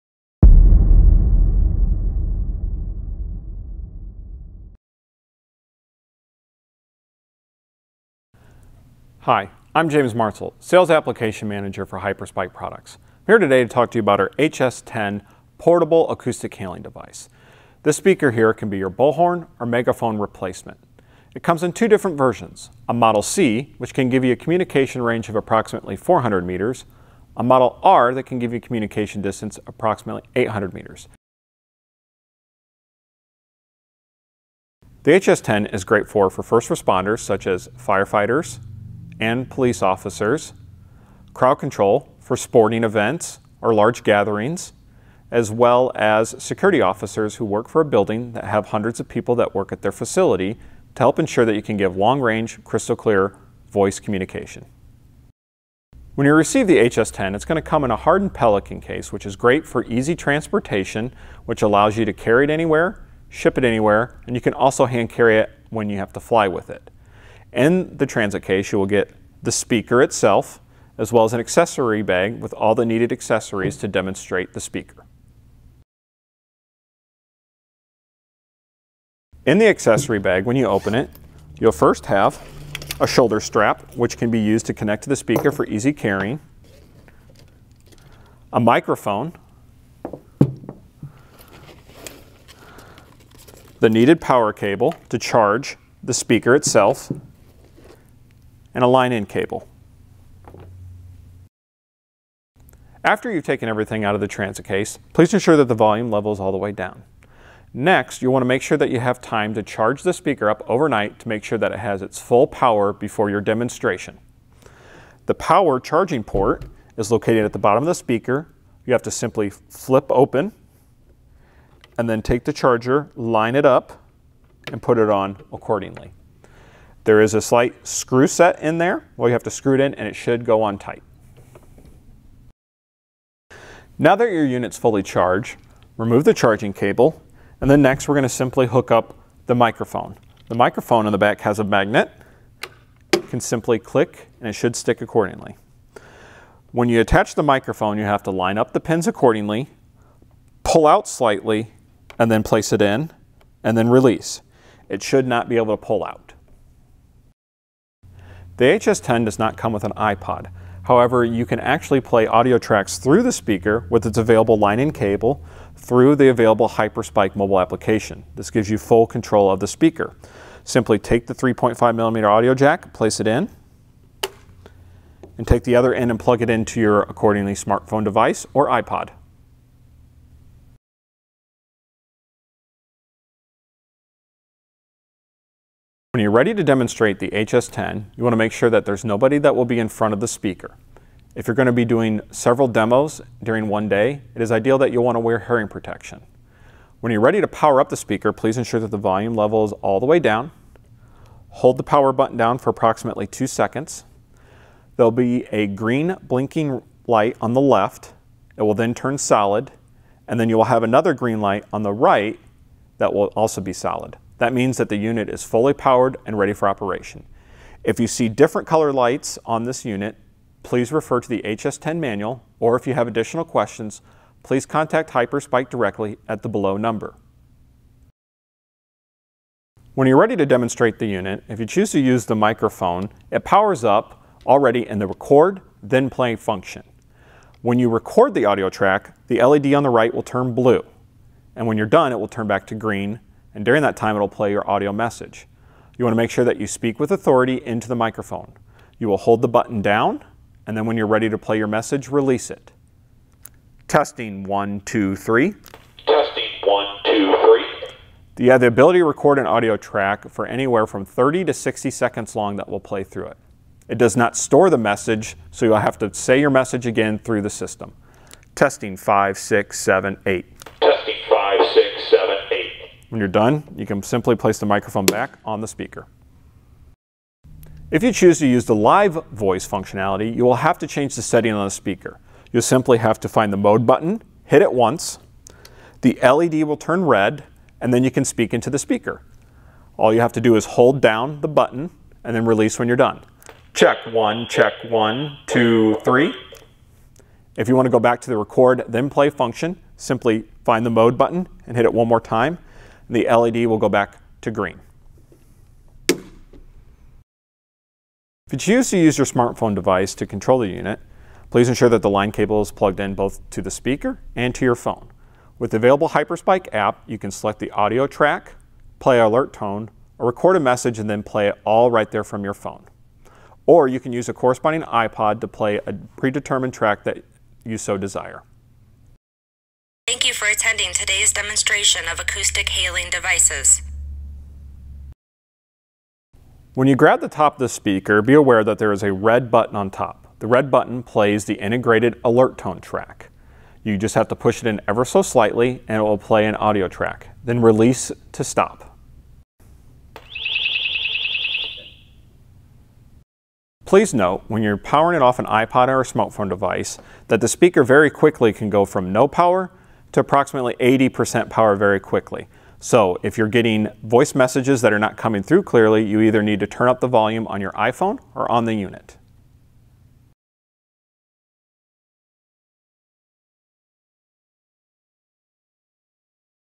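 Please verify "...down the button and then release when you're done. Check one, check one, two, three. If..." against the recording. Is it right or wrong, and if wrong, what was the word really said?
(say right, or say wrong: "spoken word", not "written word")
right.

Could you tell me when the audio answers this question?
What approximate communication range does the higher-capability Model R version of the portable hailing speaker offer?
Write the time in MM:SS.
00:30.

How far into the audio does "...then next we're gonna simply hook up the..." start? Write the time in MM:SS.
02:17.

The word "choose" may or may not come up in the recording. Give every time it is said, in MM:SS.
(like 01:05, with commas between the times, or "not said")
03:51, 04:38, 05:08.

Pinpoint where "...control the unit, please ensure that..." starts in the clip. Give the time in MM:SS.
05:10.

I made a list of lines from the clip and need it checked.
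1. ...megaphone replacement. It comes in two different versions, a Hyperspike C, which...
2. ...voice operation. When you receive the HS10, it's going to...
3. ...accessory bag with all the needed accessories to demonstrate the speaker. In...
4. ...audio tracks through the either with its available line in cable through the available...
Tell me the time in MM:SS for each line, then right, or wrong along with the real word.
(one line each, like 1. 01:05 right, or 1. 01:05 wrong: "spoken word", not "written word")
1. 00:19 wrong: "Model", not "Hyperspike"
2. 00:53 wrong: "communication", not "operation"
3. 01:11 right
4. 02:42 wrong: "speaker", not "either".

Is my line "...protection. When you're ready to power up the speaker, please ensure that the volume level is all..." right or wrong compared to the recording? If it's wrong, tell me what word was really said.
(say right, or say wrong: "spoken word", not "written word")
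right.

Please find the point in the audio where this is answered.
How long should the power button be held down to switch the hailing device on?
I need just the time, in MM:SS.
03:23.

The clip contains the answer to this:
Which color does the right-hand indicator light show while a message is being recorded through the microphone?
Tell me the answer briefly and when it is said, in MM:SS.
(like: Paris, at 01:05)
Blue, at 04:00.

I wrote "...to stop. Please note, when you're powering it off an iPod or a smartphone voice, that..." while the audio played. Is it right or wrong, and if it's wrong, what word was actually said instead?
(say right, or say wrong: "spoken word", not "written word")
wrong: "device", not "voice".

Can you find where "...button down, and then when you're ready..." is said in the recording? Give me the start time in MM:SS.
04:09.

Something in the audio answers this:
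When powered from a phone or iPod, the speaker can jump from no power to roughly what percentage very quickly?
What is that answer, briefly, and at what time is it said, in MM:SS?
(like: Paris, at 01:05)
80%, at 06:00.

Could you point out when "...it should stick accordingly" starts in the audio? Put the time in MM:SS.
02:24.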